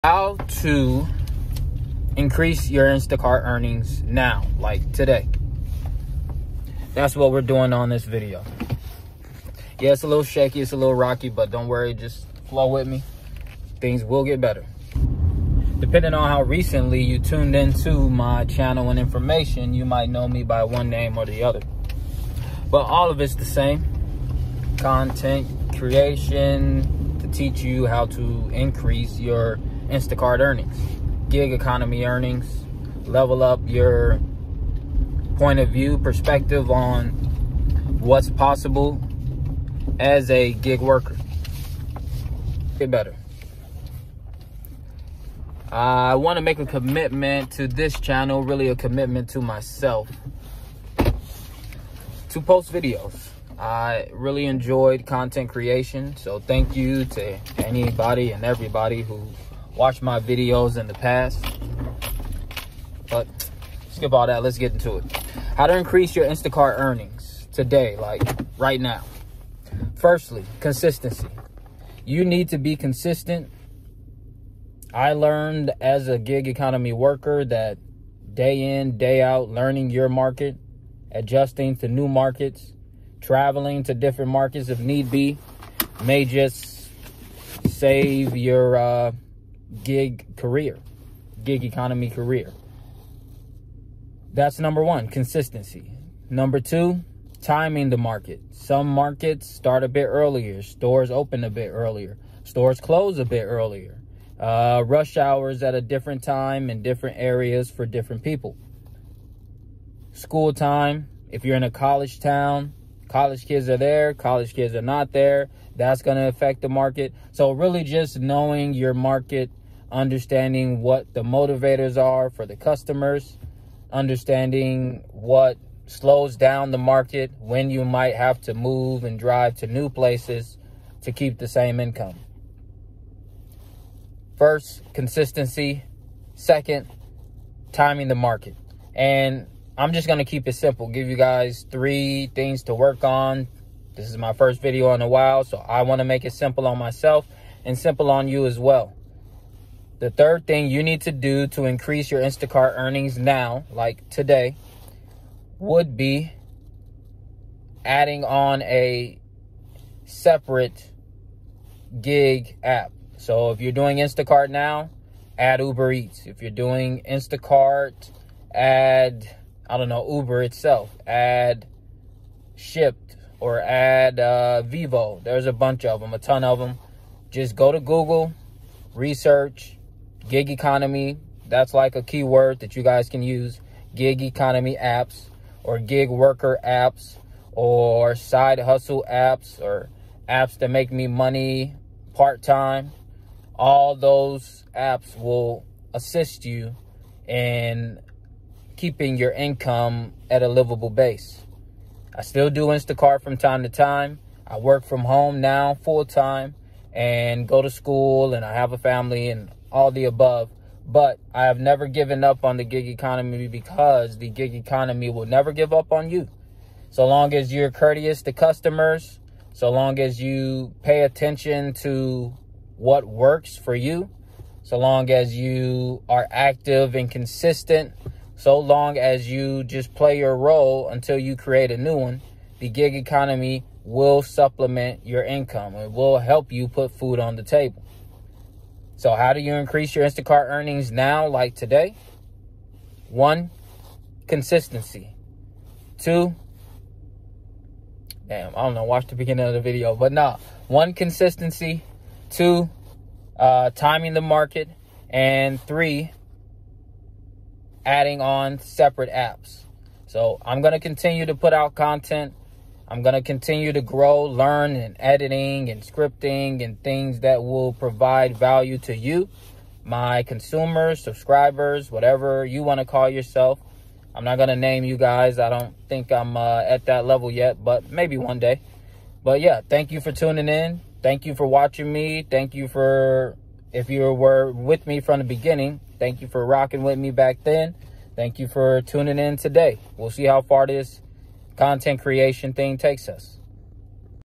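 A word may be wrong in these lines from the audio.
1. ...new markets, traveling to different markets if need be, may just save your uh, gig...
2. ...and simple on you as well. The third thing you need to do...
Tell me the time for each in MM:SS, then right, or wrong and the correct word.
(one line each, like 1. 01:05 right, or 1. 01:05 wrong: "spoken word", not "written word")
1. 01:21 right
2. 02:27 right.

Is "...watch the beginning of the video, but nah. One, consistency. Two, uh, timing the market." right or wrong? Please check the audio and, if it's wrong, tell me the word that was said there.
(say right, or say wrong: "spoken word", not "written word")
right.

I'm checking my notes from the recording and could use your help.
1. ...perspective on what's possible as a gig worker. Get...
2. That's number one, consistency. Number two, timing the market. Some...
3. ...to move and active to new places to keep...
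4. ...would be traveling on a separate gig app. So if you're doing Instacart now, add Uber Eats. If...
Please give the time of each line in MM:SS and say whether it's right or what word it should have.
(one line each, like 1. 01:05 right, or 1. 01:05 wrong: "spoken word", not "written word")
1. 00:35 right
2. 01:34 right
3. 02:08 wrong: "drive", not "active"
4. 02:35 wrong: "adding", not "traveling".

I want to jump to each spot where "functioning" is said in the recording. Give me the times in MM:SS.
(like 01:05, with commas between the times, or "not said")
not said.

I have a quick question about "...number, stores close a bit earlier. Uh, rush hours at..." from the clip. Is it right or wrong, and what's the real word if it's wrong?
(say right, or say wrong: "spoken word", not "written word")
wrong: "earlier", not "number".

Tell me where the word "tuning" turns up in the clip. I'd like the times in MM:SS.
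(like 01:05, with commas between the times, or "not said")
04:40, 04:48.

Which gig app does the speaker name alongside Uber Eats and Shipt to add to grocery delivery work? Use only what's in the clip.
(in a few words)
Vivo.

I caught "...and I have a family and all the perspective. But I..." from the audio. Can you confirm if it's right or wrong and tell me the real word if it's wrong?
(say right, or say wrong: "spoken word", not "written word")
wrong: "above", not "perspective".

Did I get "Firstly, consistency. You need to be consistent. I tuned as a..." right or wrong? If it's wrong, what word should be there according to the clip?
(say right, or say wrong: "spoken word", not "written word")
wrong: "learned", not "tuned".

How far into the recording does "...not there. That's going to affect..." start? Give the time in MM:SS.
01:54.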